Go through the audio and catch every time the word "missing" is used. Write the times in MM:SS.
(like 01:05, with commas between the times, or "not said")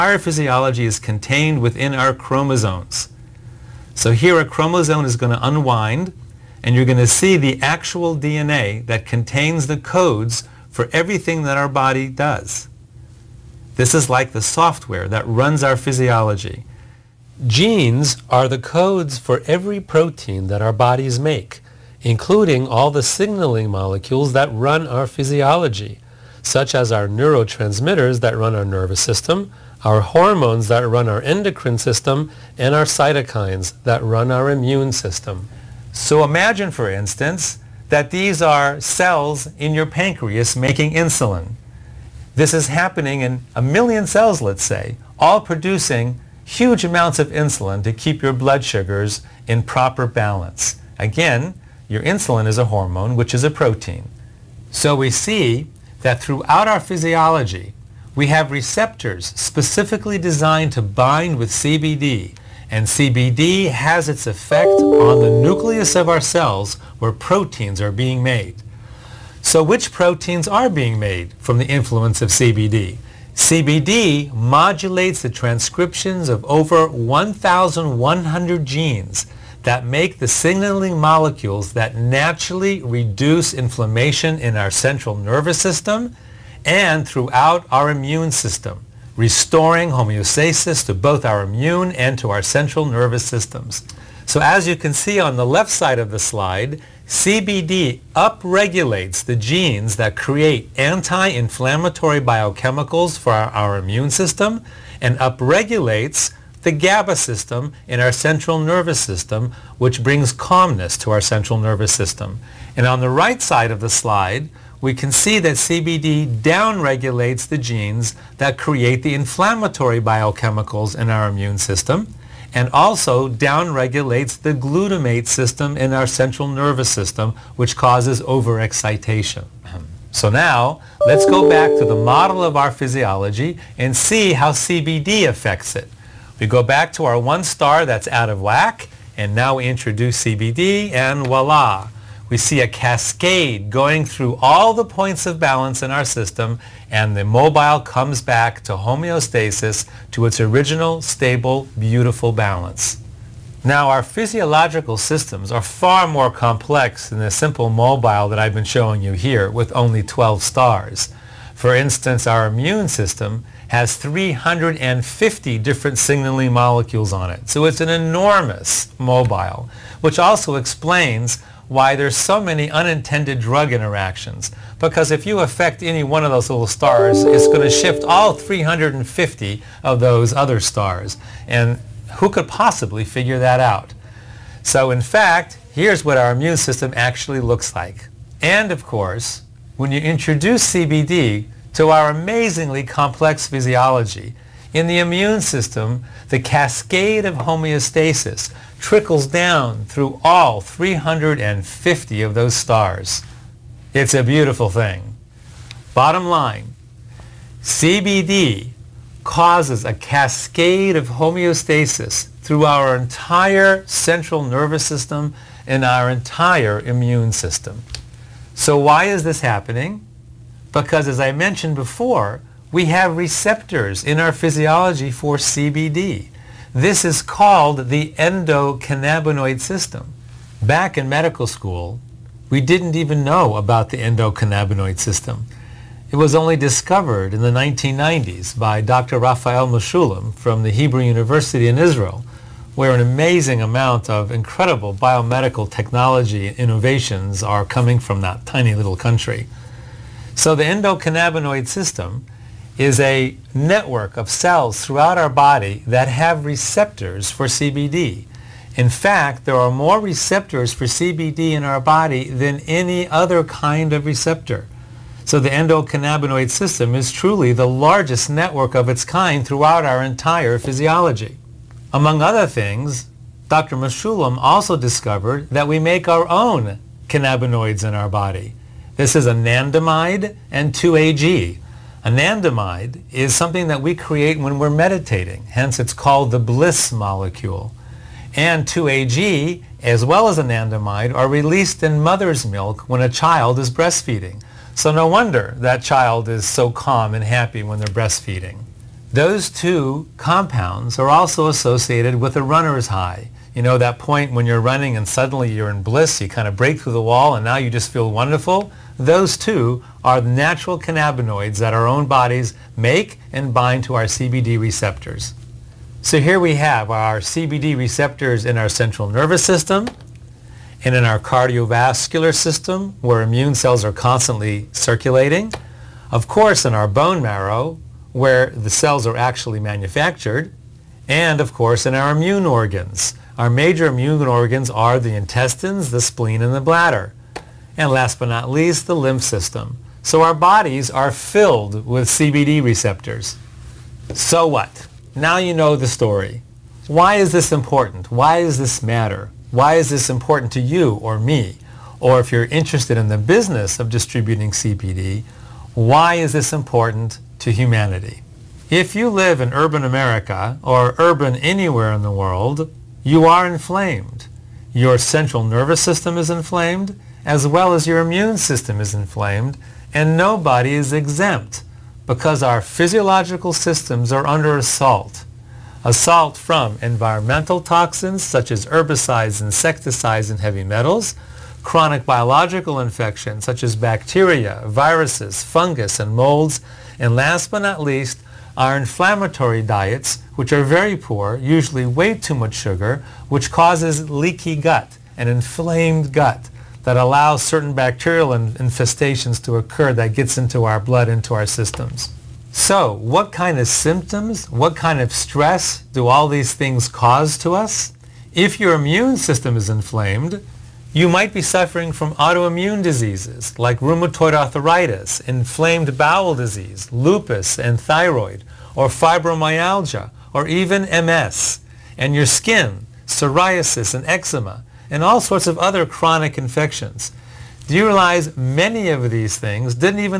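not said.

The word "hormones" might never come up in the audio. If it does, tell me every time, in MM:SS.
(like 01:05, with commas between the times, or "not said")
00:30, 00:52.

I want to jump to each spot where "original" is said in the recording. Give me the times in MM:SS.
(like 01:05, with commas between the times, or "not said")
02:30.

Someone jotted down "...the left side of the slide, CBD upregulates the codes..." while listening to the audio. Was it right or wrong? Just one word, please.
wrong.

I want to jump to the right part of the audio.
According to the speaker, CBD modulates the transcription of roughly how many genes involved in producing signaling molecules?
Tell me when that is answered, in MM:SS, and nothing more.
01:16.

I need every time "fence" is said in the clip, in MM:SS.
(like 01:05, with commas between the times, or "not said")
not said.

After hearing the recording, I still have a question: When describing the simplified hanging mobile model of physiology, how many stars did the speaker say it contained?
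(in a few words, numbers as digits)
12.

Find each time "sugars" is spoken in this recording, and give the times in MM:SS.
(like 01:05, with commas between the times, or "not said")
00:48, 06:32.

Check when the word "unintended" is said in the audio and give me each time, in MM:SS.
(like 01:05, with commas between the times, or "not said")
02:52.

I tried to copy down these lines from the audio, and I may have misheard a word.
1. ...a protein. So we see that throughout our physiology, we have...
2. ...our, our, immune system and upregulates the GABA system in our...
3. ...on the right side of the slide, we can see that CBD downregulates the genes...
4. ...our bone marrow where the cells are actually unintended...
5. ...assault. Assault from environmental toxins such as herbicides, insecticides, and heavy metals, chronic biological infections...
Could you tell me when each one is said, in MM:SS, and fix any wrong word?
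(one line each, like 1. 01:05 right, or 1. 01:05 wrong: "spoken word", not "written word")
1. 00:53 right
2. 01:43 right
3. 01:52 right
4. 05:26 wrong: "manufactured", not "unintended"
5. 06:14 right.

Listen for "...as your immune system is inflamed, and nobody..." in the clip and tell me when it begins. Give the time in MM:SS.
06:07.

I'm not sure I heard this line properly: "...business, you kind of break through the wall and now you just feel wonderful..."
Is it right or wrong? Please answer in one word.
wrong.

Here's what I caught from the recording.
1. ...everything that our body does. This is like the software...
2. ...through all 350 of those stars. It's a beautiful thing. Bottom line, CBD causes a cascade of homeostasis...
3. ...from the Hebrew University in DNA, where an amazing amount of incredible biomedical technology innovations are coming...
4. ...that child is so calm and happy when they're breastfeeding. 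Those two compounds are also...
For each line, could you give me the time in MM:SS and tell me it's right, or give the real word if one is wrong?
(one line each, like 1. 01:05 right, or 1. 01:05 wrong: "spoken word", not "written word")
1. 00:10 right
2. 03:19 right
3. 04:00 wrong: "Israel", not "DNA"
4. 04:55 right.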